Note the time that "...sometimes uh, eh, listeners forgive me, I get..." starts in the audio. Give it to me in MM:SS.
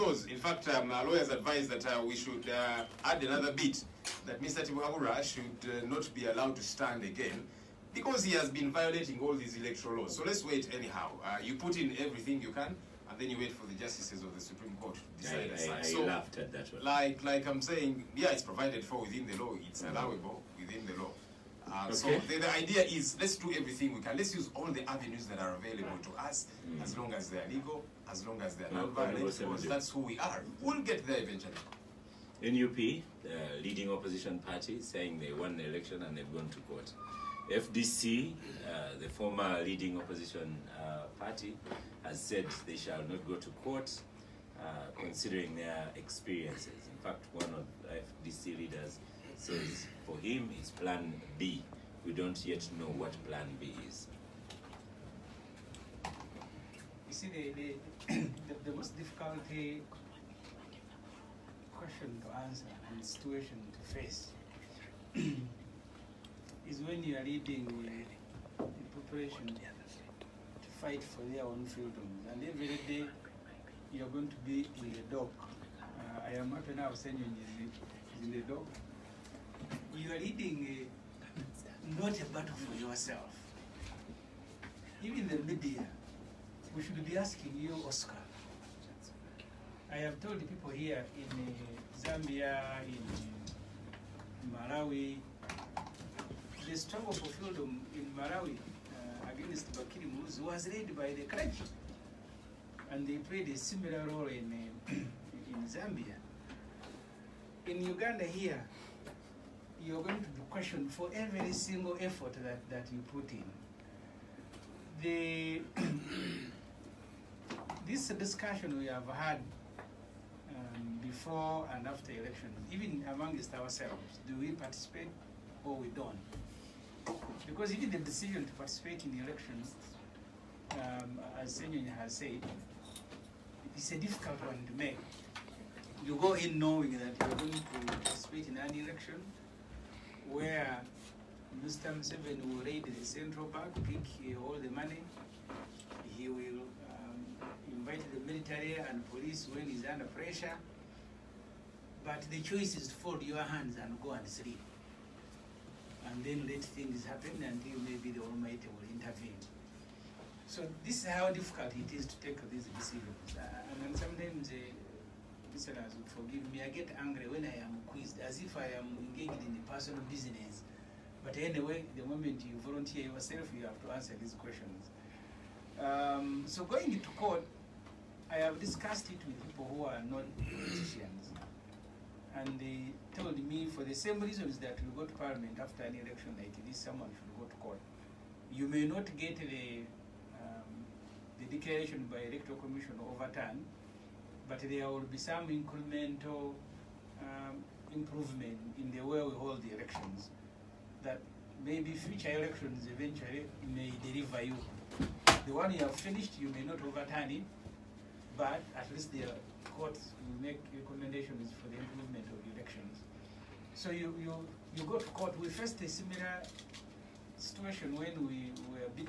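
02:43.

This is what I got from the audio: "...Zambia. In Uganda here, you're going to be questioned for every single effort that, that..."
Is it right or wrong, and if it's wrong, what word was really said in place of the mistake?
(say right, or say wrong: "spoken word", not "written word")
right.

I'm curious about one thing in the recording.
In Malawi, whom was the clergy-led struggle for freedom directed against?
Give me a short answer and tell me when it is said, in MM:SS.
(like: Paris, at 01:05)
Bakili Muluzi, at 01:39.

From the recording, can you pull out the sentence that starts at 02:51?
But anyway, the moment you volunteer yourself, you have to answer these questions.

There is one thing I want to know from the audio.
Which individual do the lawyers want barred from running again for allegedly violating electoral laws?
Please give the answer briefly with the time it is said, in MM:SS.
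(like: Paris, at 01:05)
Mr. Tibuhaburwa, at 00:04.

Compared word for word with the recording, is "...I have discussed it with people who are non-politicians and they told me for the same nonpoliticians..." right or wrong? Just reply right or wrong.
wrong.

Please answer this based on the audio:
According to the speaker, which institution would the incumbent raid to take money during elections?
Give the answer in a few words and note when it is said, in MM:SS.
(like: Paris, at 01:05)
the central bank, at 02:23.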